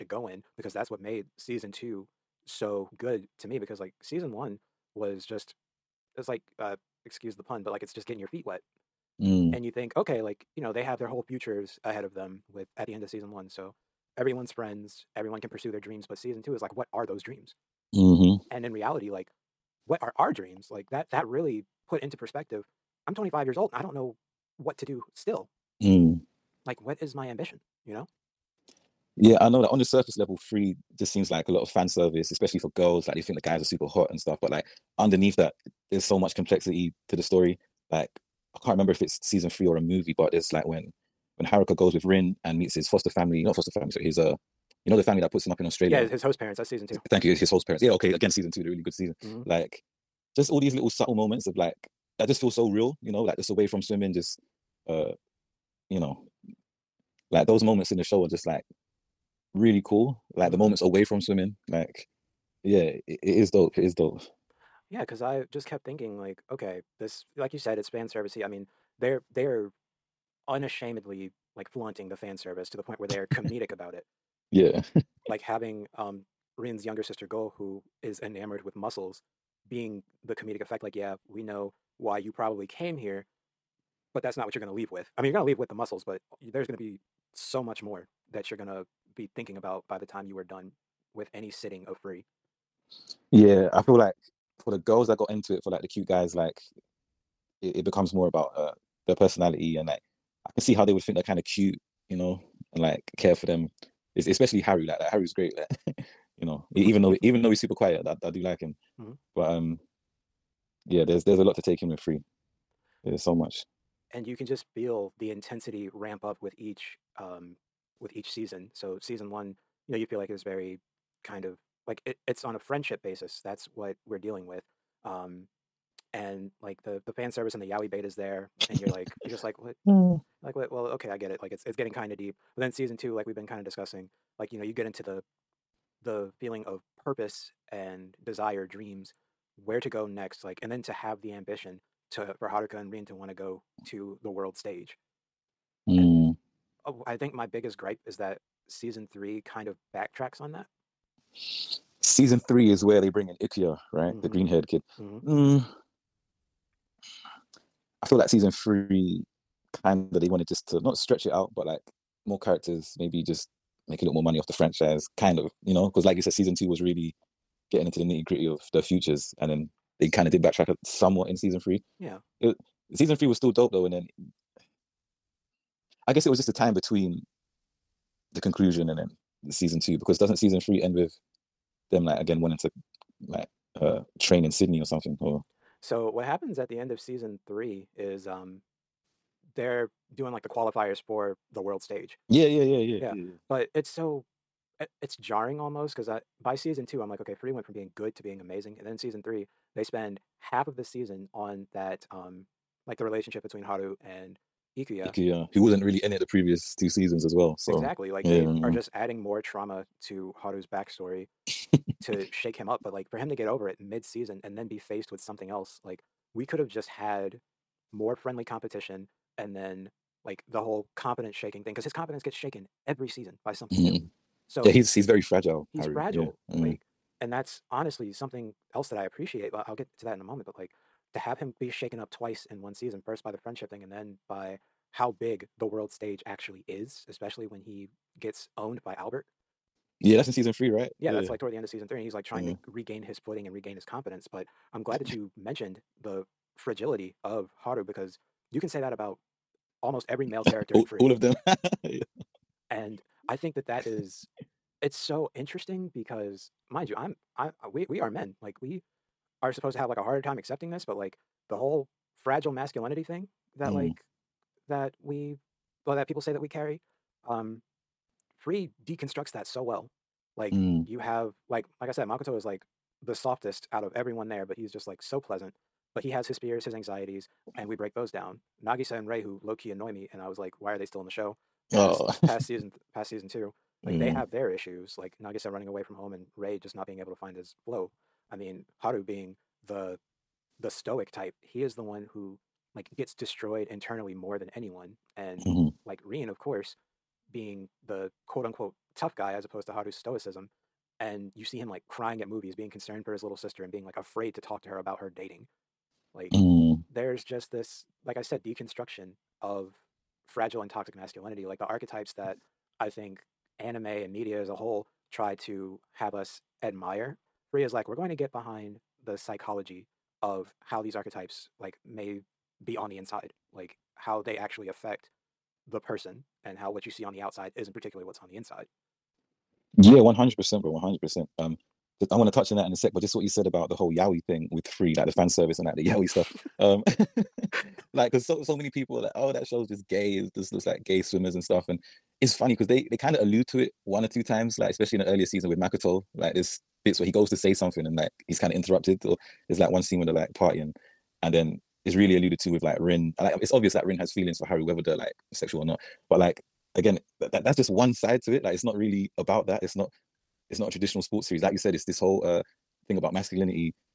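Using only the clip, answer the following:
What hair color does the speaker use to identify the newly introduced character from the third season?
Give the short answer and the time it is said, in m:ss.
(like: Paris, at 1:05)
Green, at 2:34.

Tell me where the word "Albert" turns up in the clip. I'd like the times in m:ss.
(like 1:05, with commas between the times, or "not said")
3:58.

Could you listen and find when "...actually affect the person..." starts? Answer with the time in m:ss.
5:24.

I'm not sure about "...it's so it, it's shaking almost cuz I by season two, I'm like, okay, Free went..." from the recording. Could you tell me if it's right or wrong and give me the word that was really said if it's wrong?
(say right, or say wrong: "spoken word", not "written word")
wrong: "jarring", not "shaking".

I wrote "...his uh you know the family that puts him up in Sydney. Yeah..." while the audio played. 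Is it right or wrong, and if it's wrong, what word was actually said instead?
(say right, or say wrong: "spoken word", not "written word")
wrong: "Australia", not "Sydney".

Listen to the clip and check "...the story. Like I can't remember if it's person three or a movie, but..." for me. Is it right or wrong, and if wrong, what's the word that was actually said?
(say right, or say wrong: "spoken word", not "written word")
wrong: "season", not "person".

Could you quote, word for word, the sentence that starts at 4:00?
Yeah, that's in season three, right?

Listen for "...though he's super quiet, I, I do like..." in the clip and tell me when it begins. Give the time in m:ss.
1:47.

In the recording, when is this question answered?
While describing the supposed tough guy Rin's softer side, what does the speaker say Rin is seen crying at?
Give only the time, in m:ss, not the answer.
5:02.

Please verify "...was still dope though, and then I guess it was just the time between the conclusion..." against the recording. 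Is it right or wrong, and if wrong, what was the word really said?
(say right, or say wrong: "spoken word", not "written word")
right.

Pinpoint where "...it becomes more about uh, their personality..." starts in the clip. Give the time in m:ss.
1:37.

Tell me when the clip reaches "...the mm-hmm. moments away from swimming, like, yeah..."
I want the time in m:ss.
1:00.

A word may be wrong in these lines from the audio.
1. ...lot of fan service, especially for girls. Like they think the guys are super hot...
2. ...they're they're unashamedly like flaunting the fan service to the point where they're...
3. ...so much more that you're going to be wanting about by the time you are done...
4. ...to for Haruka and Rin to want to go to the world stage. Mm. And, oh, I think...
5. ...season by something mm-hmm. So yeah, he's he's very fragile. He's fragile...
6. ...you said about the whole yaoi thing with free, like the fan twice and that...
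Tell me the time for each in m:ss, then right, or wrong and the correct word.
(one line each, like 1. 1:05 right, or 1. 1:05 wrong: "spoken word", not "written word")
1. 0:31 right
2. 1:08 right
3. 1:27 wrong: "thinking", not "wanting"
4. 2:22 right
5. 3:43 right
6. 5:33 wrong: "service", not "twice".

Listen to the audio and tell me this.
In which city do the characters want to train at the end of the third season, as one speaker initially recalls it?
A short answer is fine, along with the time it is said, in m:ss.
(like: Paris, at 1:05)
Sydney, at 3:04.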